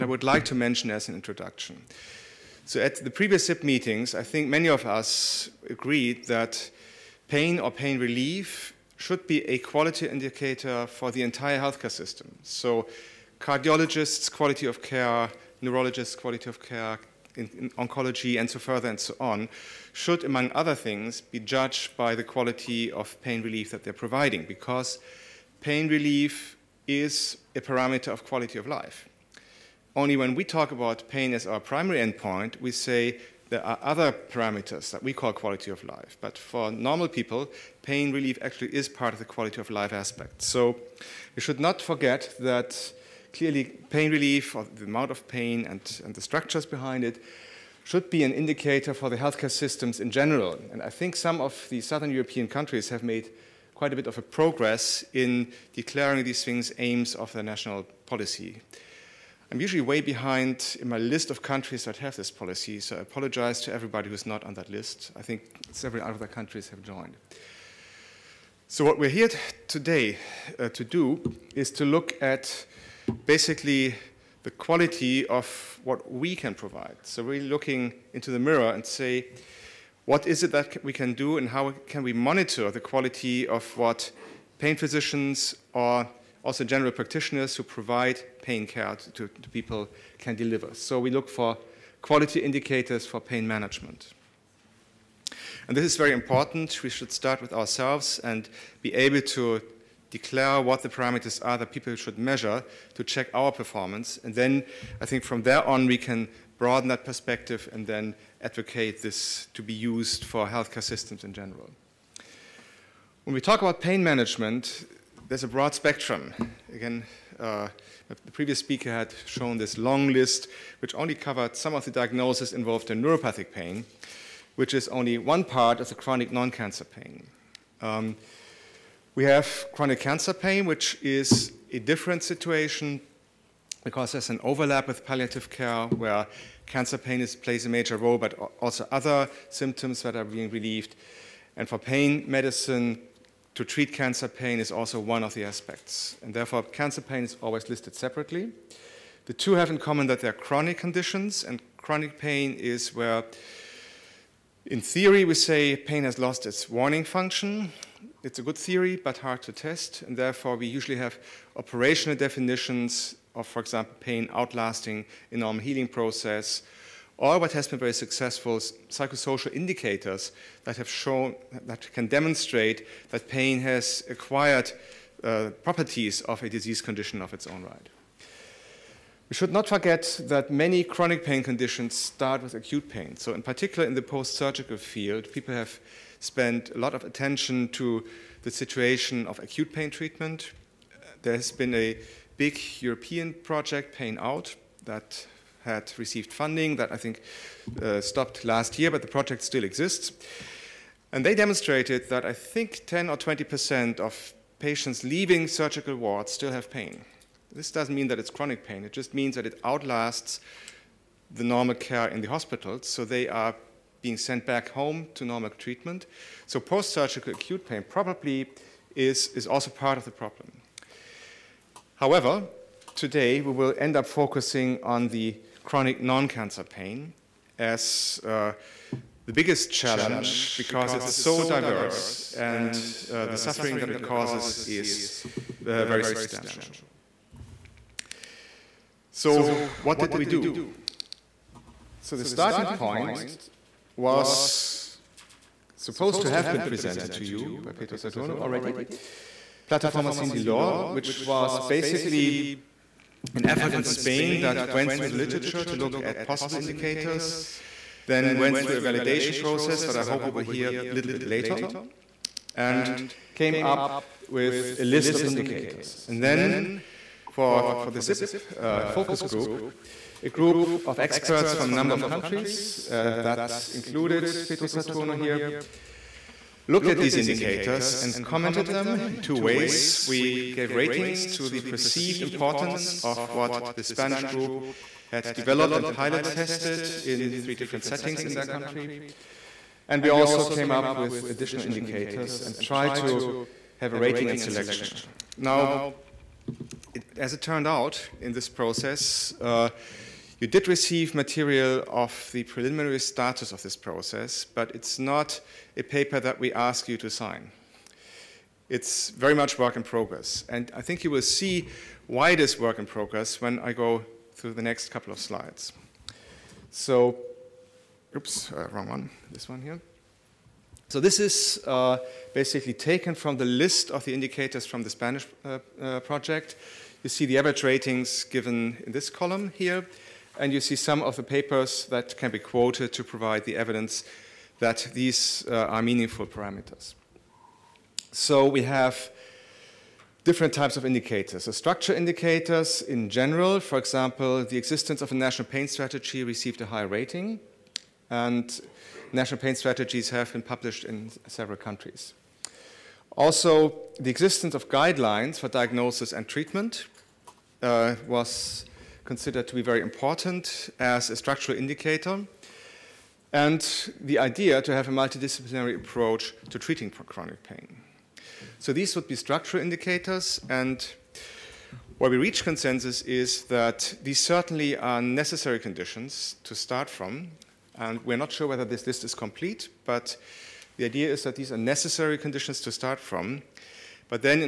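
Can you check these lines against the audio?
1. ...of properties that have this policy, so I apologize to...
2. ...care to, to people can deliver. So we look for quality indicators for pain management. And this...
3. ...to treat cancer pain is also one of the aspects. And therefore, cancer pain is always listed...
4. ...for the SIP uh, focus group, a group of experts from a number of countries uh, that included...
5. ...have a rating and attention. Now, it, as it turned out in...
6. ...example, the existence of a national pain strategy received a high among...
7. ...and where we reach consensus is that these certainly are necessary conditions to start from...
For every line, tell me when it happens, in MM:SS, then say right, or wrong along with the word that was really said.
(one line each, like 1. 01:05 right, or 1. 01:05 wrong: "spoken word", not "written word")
1. 01:01 wrong: "countries", not "properties"
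2. 01:28 right
3. 02:23 right
4. 04:27 right
5. 04:53 wrong: "selection", not "attention"
6. 05:43 wrong: "rating", not "among"
7. 06:10 right.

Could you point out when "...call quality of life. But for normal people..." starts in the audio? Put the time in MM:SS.
00:35.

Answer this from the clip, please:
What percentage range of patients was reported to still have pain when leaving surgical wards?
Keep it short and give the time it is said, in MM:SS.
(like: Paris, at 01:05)
10 or 20 percent, at 03:22.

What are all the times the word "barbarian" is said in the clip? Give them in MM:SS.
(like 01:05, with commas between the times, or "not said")
not said.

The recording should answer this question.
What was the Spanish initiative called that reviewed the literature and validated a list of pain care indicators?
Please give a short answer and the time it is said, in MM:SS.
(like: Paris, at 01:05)
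Plataforma Sin Dolor, at 04:09.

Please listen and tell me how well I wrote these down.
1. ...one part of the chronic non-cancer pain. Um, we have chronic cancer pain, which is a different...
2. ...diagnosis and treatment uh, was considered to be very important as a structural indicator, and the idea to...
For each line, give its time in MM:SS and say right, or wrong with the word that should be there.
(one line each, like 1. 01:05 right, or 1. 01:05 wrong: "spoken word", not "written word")
1. 02:05 right
2. 05:55 right.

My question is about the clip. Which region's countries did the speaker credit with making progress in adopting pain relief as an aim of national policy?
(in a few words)
southern European.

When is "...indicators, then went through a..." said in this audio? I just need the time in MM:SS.
04:16.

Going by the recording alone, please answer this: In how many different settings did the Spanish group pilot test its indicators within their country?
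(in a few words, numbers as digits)
3.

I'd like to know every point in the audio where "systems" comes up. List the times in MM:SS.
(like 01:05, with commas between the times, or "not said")
00:11, 00:49, 01:50.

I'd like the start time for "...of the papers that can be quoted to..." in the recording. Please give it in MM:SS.
05:31.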